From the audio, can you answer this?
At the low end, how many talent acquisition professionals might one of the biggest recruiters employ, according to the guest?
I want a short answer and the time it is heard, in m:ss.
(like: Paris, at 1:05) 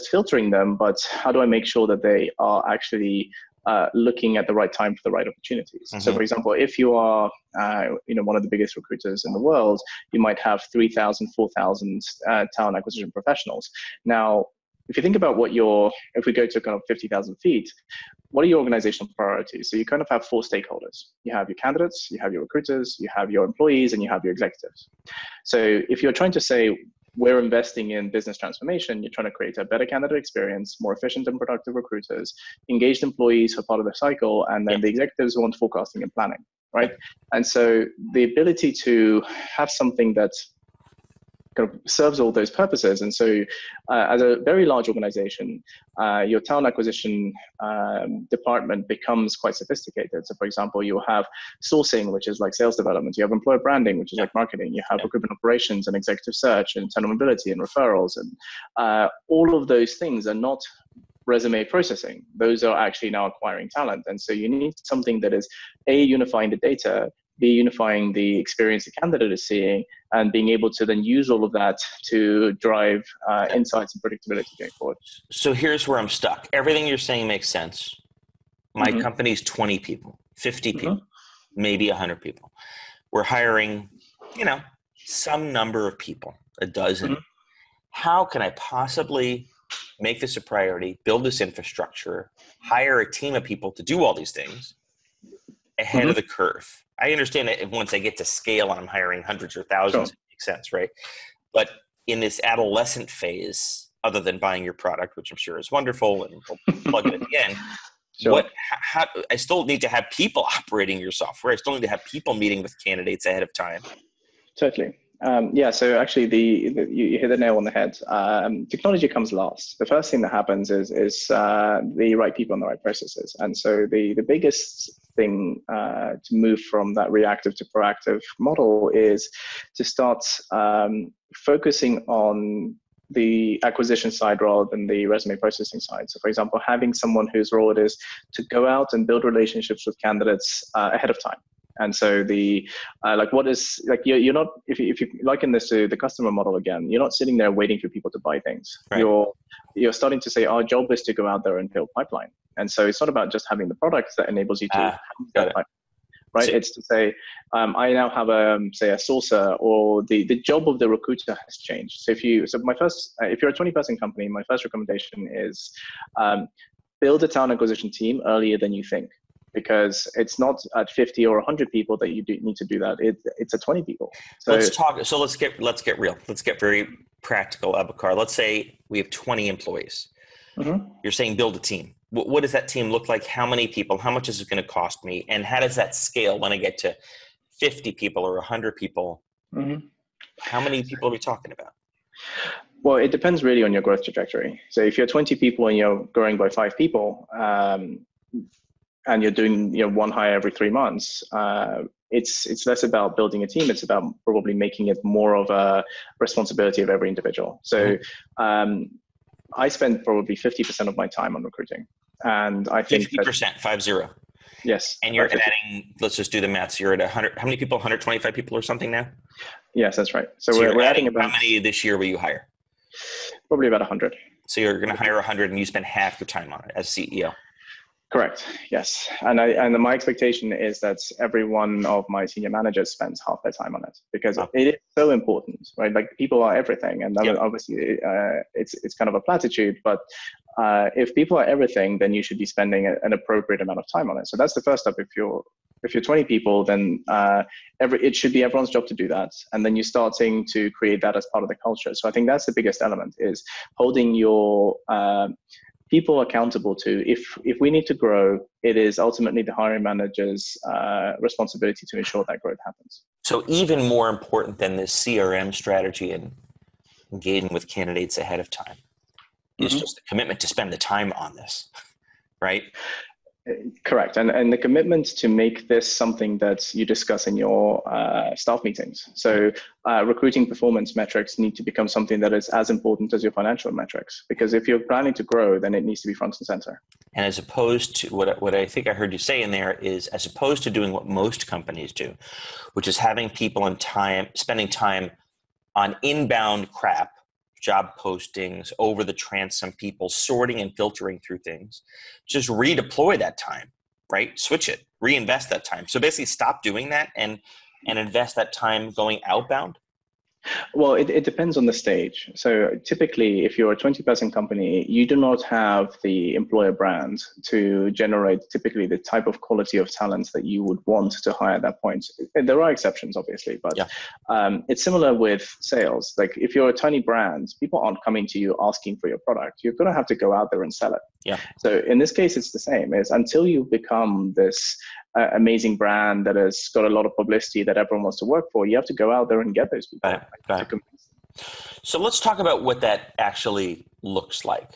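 3,000, at 0:10.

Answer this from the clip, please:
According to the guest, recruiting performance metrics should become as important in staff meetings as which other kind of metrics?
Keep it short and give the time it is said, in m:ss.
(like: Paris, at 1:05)
financial metrics, at 4:43.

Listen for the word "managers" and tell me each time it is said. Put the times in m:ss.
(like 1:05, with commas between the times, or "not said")
3:52, 4:19.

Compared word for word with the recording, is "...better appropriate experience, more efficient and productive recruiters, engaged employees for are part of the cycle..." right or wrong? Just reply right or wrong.
wrong.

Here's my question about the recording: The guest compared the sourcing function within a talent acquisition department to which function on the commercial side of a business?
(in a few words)
sales development.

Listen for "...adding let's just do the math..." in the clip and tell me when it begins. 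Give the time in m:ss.
3:35.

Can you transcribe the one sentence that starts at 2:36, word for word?
It's to say, um, I now have a um, say a sourcer or the the job of the recruiter has changed.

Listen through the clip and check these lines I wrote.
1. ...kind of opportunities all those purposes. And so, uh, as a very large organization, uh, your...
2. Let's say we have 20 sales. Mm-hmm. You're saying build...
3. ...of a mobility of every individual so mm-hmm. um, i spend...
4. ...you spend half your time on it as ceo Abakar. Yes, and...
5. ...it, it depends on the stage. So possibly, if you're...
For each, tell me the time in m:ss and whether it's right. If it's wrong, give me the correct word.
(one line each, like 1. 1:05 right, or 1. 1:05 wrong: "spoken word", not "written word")
1. 0:41 wrong: "serves", not "opportunities"
2. 2:58 wrong: "employees", not "sales"
3. 3:25 wrong: "responsibility", not "mobility"
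4. 3:45 wrong: "Correct", not "Abakar"
5. 5:10 wrong: "typically", not "possibly".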